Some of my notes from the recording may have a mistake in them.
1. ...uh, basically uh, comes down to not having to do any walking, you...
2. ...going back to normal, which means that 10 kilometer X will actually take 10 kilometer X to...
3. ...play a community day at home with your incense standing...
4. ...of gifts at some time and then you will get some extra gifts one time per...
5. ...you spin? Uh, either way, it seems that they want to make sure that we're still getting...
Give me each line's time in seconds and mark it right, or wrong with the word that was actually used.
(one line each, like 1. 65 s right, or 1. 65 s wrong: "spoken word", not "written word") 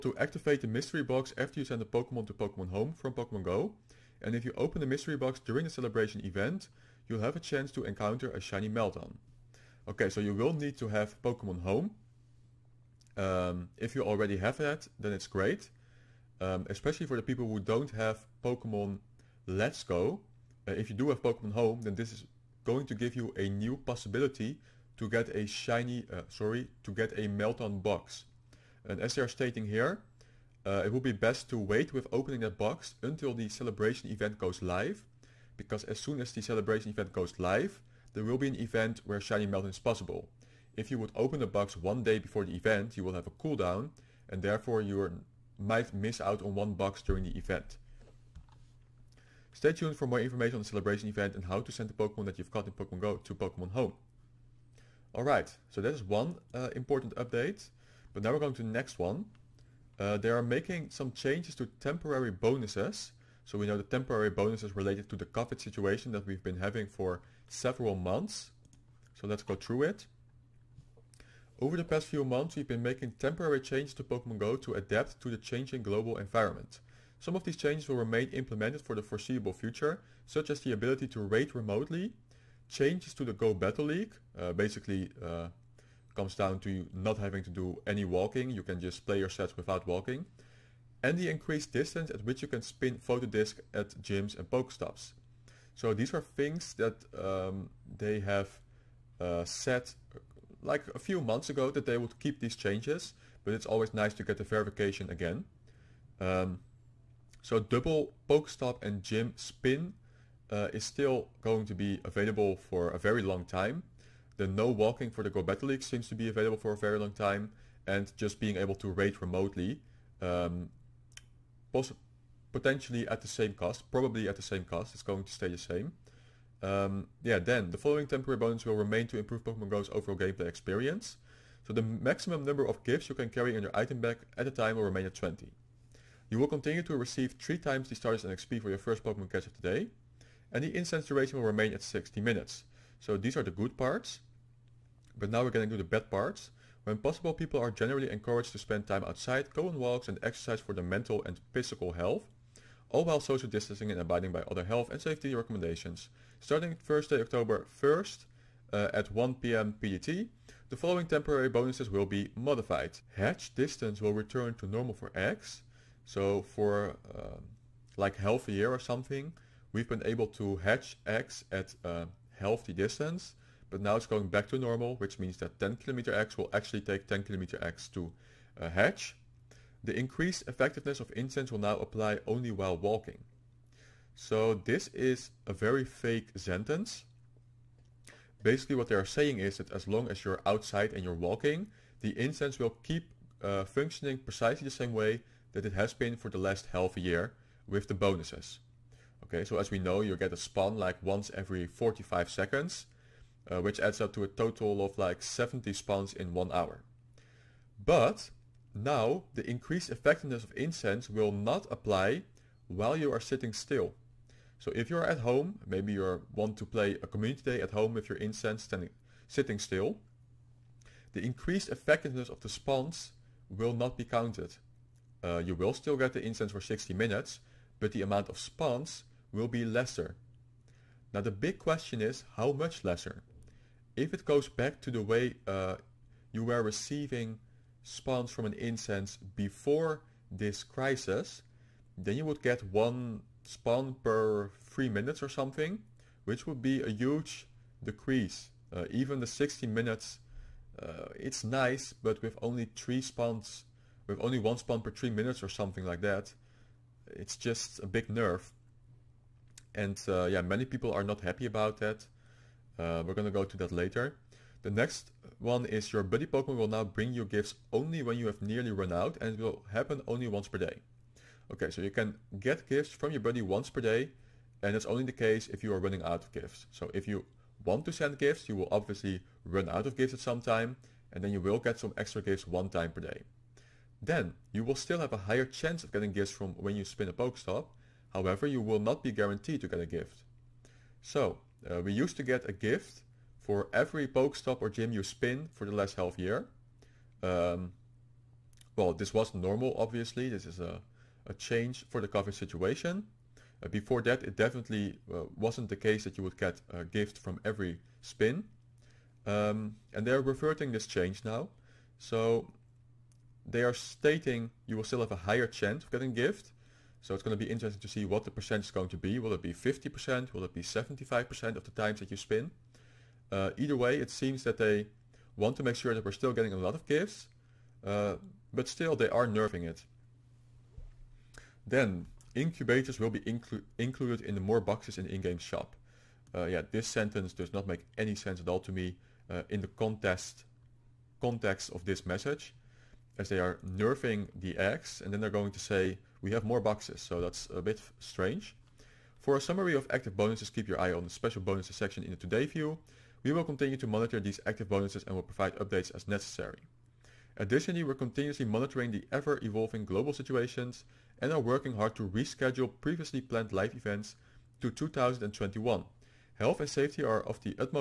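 1. 84 s right
2. 174 s right
3. 216 s right
4. 279 s right
5. 322 s right.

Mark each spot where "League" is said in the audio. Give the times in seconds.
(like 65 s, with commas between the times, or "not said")
83 s, 115 s.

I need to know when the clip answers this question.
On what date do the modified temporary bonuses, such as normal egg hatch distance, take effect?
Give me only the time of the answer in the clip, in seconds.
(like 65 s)
157 s.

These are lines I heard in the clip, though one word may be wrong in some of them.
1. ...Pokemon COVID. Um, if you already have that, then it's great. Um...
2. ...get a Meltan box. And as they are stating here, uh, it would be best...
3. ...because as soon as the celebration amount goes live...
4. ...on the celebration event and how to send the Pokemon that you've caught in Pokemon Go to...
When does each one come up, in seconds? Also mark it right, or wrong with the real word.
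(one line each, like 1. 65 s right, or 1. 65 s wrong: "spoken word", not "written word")
1. 11 s wrong: "Home", not "COVID"
2. 26 s right
3. 35 s wrong: "event", not "amount"
4. 50 s right.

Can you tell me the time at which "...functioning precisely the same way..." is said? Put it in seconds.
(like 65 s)
193 s.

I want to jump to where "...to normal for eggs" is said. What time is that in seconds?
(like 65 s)
164 s.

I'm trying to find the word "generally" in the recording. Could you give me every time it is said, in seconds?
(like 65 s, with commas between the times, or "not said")
147 s.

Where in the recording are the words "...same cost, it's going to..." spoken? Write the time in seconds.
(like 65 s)
124 s.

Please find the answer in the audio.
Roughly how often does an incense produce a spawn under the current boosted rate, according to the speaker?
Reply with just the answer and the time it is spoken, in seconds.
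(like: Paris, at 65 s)
every 45 seconds, at 201 s.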